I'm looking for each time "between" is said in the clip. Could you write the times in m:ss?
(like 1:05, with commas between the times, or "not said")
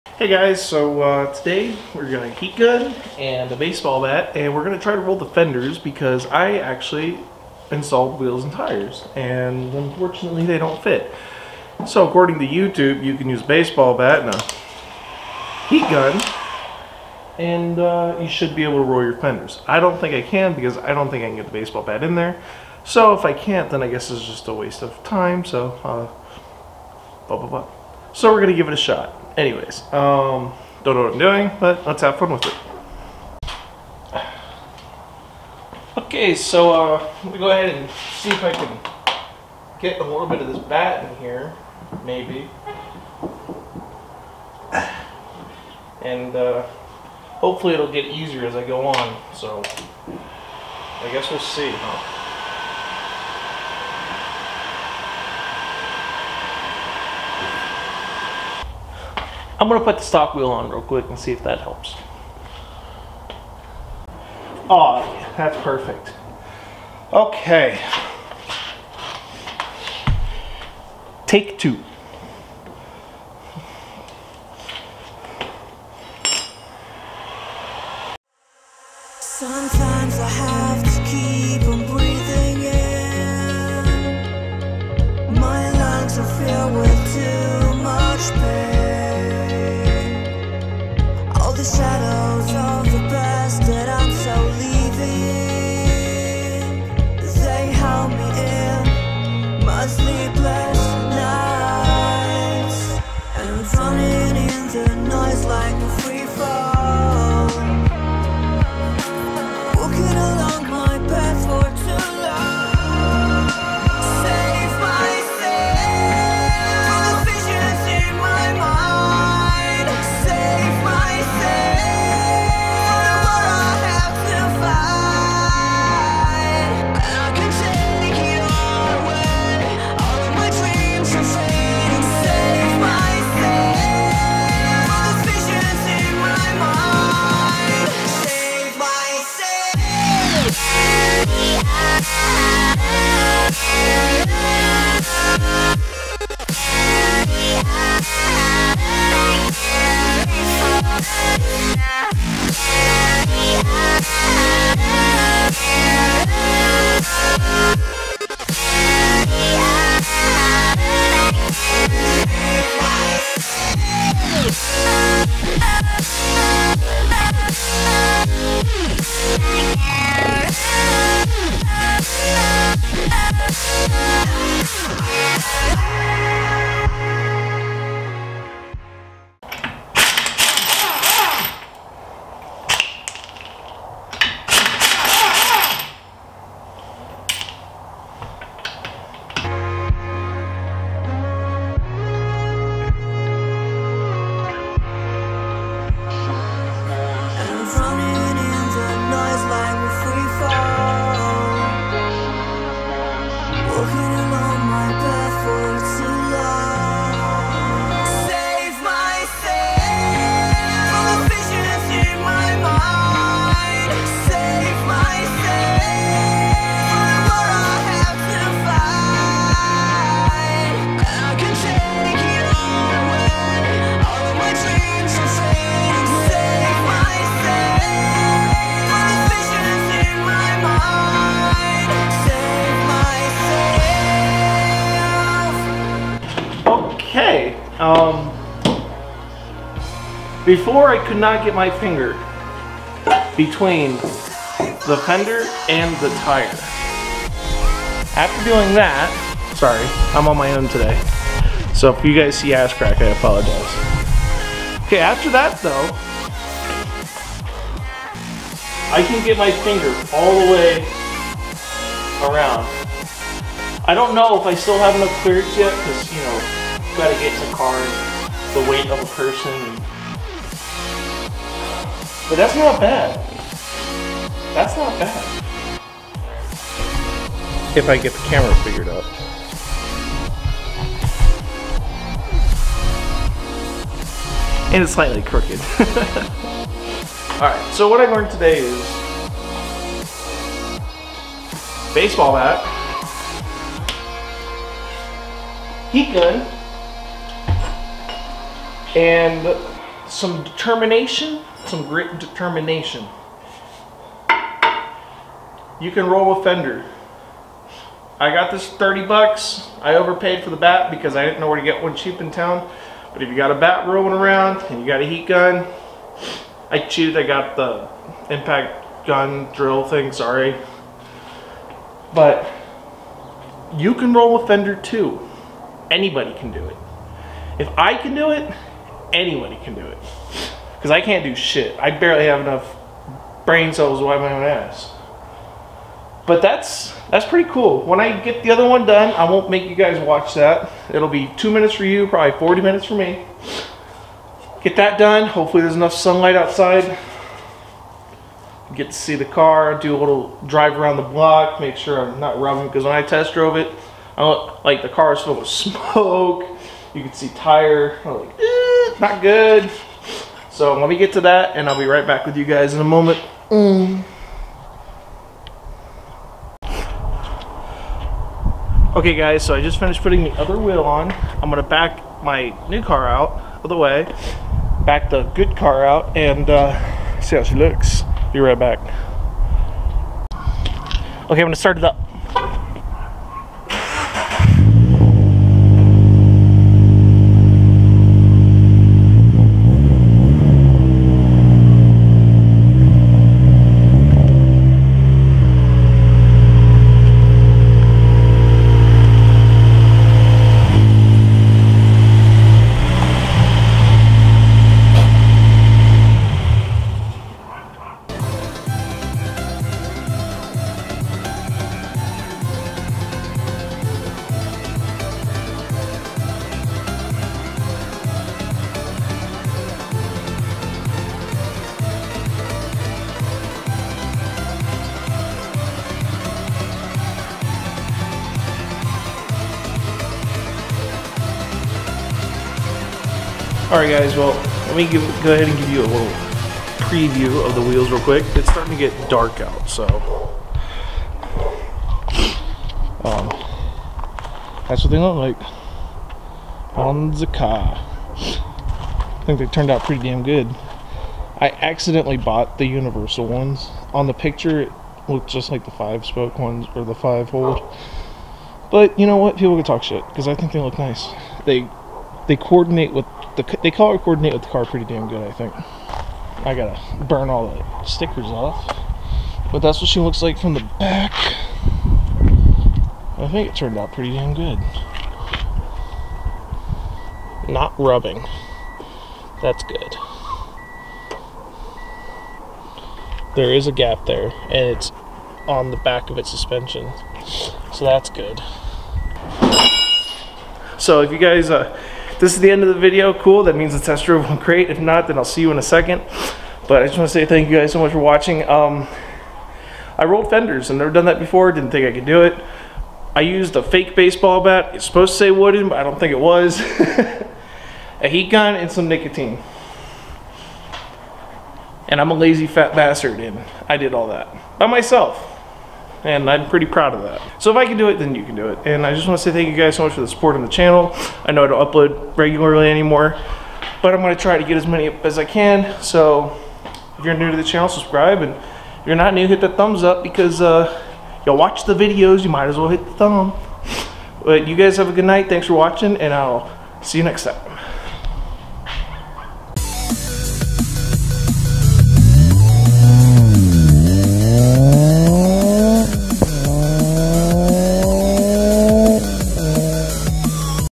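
4:03.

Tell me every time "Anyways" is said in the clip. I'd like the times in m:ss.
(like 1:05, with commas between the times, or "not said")
0:29.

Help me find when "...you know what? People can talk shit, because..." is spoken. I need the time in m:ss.
7:38.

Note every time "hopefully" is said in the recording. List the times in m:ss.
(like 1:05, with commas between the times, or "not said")
0:47, 5:45.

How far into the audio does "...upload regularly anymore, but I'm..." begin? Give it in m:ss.
8:41.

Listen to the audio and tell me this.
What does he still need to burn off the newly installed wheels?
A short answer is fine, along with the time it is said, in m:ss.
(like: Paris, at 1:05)
stickers, at 7:47.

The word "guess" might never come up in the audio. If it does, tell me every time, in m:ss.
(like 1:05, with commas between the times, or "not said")
0:23, 0:51.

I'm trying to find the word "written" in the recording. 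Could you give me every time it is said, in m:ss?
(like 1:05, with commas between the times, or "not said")
not said.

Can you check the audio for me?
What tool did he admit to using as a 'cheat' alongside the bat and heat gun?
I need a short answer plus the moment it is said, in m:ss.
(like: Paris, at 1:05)
impact gun, at 5:18.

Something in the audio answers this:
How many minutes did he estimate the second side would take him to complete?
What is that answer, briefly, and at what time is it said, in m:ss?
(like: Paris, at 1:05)
40 minutes, at 5:42.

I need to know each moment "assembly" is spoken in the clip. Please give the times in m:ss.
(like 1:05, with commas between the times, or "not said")
not said.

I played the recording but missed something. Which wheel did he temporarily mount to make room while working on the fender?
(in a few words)
stock wheel.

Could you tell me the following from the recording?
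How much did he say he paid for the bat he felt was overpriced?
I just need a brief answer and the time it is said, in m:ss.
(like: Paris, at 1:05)
30 bucks, at 5:08.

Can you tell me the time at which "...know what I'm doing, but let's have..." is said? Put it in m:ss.
0:30.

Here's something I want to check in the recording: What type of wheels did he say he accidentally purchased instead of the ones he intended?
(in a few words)
universal.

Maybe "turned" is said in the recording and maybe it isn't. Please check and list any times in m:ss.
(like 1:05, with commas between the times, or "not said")
7:29, 7:53.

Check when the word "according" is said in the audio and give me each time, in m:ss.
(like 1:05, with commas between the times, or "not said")
0:12.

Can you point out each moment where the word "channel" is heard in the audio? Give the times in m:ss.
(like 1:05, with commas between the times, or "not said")
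8:40, 8:47.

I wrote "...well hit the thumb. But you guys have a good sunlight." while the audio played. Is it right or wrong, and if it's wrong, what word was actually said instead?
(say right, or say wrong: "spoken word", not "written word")
wrong: "night", not "sunlight".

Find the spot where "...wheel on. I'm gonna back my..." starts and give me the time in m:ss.
6:10.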